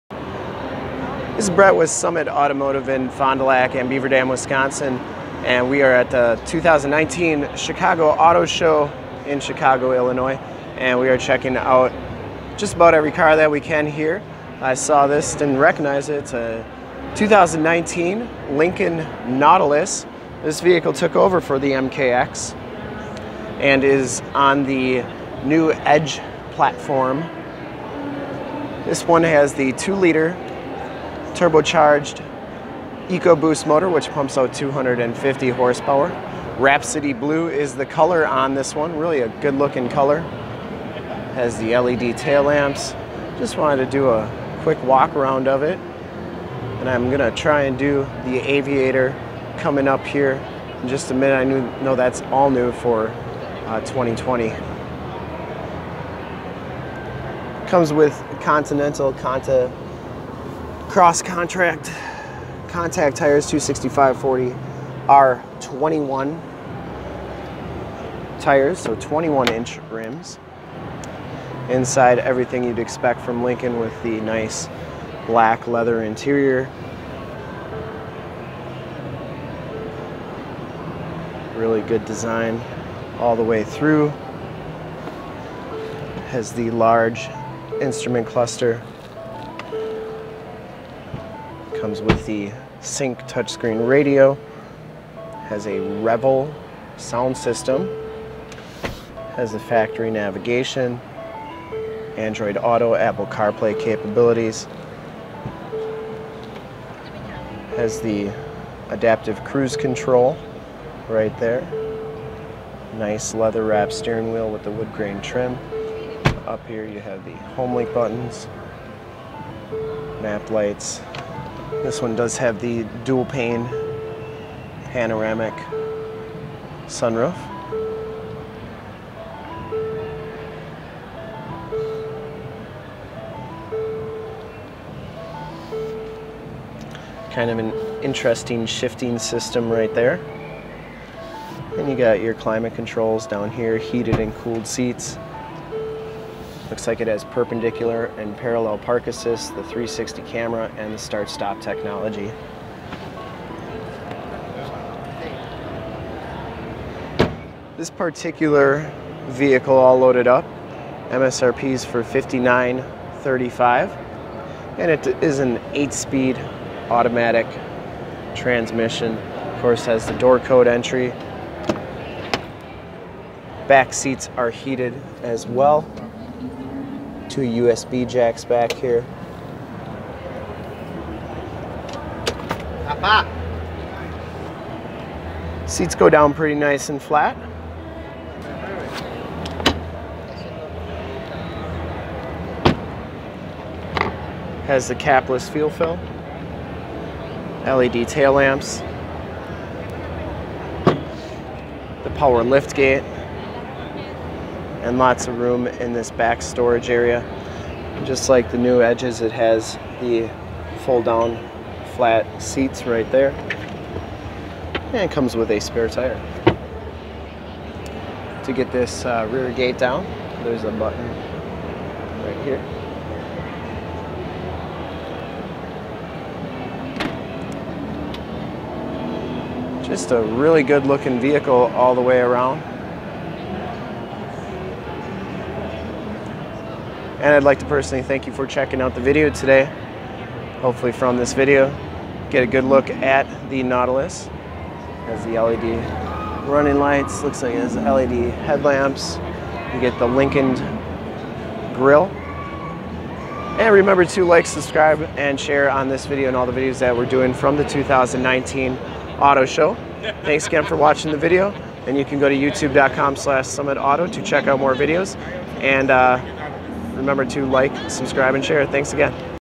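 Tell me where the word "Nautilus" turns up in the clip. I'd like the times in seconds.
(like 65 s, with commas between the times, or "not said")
19 s, 243 s.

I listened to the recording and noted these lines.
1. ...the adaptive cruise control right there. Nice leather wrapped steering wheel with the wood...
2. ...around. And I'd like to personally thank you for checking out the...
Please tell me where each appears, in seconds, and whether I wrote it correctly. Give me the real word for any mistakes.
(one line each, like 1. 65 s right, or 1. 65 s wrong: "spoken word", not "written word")
1. 108 s right
2. 232 s right.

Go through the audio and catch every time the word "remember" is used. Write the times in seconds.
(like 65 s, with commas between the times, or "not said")
253 s, 266 s.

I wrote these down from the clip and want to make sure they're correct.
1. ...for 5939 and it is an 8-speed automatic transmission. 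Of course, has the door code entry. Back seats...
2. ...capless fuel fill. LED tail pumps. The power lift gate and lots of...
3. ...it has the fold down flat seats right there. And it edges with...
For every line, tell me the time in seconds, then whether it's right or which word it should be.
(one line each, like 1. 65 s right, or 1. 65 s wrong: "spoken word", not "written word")
1. 161 s wrong: "5935", not "5939"
2. 194 s wrong: "lamps", not "pumps"
3. 209 s wrong: "comes", not "edges".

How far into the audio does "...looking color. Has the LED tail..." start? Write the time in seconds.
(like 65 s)
39 s.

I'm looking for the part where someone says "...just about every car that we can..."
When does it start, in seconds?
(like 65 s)
12 s.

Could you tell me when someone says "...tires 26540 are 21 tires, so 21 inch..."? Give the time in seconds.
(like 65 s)
63 s.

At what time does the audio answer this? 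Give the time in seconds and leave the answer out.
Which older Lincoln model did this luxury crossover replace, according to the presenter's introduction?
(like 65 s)
21 s.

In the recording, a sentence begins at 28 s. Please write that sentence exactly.
This one has the 2 liter turbocharged EcoBoost motor, which pumps out 250 horsepower.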